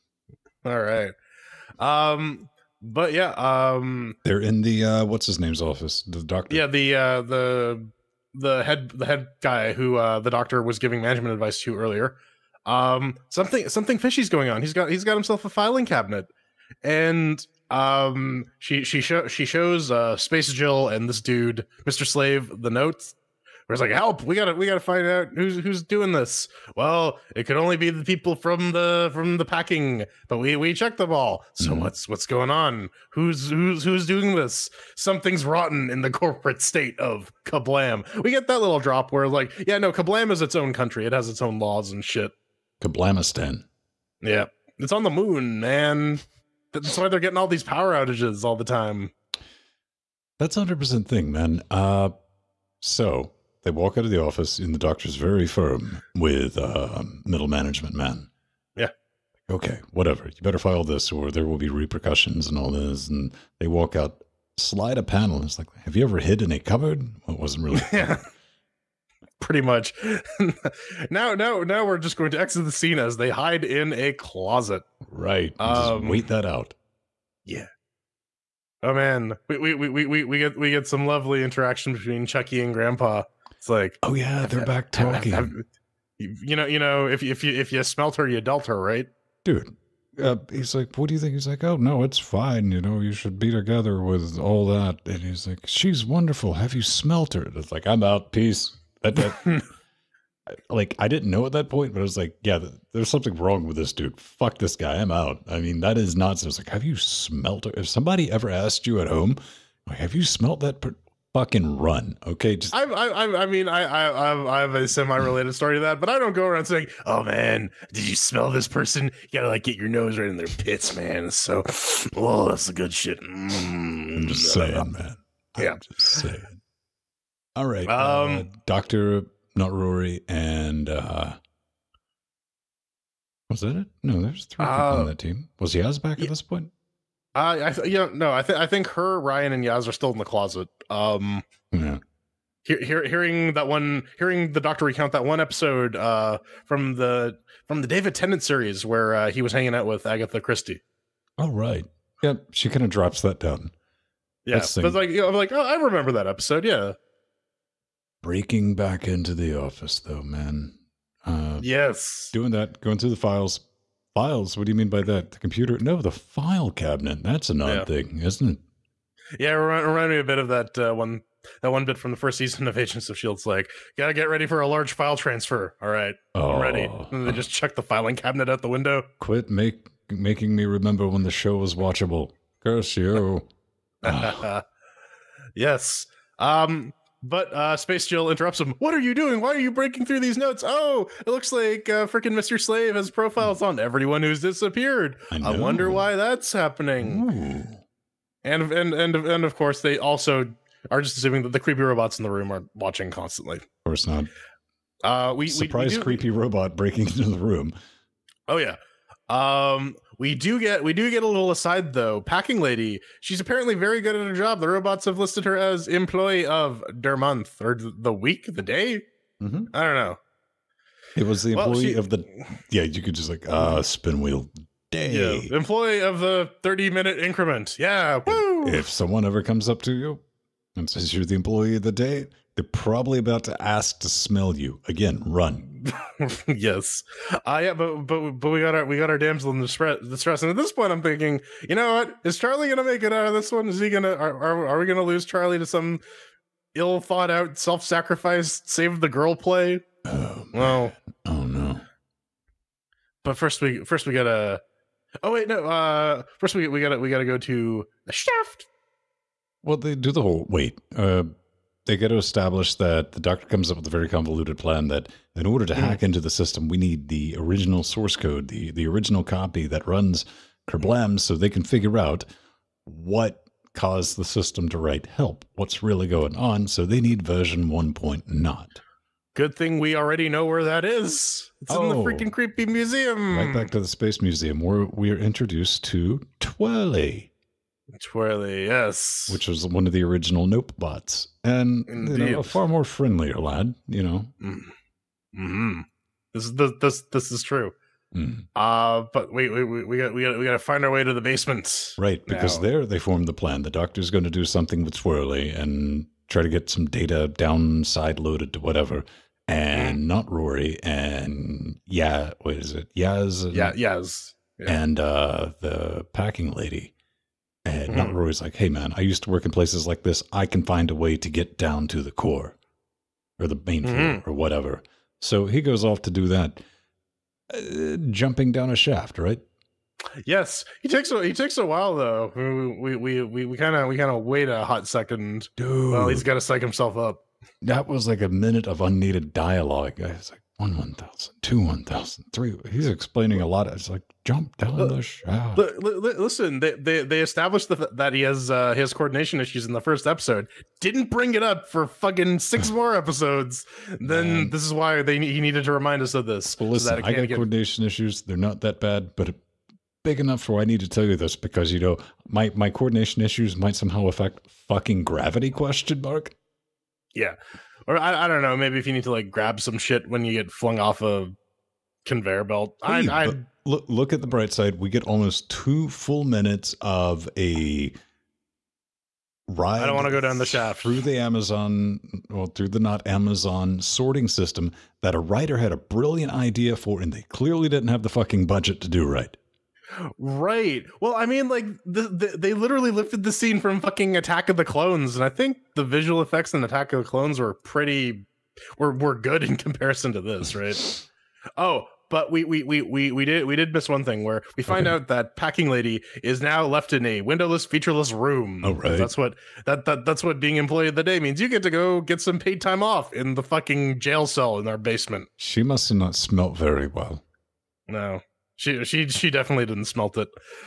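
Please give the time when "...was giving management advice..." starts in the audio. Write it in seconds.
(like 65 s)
10 s.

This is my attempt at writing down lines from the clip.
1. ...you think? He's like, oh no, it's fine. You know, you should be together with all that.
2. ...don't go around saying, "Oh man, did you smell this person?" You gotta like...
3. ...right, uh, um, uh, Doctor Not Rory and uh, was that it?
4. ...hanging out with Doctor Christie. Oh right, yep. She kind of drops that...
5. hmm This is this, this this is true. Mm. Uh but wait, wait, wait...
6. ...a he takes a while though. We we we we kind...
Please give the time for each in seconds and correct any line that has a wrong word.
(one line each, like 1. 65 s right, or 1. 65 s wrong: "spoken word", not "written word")
1. 91 s right
2. 116 s right
3. 127 s right
4. 149 s wrong: "Agatha", not "Doctor"
5. 295 s right
6. 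331 s right.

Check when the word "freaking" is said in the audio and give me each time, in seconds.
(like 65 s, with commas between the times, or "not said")
192 s, 282 s.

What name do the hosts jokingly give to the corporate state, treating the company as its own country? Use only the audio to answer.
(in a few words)
Kerblamistan.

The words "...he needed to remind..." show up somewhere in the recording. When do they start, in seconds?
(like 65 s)
355 s.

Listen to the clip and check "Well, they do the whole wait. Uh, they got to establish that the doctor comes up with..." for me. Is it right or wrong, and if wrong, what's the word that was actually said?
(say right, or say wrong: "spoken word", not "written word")
right.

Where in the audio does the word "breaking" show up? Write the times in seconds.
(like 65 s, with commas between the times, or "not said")
158 s, 189 s, 206 s.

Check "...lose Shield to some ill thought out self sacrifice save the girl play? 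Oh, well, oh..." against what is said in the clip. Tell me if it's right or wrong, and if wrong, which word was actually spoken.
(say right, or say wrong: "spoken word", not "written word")
wrong: "Charlie", not "Shield".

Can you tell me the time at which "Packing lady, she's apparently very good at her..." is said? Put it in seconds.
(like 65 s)
212 s.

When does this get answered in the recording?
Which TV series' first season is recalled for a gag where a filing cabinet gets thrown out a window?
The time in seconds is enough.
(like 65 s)
172 s.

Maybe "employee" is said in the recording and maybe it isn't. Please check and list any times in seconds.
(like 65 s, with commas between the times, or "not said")
215 s, 221 s, 225 s, 231 s, 410 s.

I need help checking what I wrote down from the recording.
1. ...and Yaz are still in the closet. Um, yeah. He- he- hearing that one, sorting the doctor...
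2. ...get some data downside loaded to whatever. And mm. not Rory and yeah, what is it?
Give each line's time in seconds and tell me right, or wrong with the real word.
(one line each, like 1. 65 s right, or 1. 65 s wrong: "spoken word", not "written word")
1. 139 s wrong: "hearing", not "sorting"
2. 306 s right.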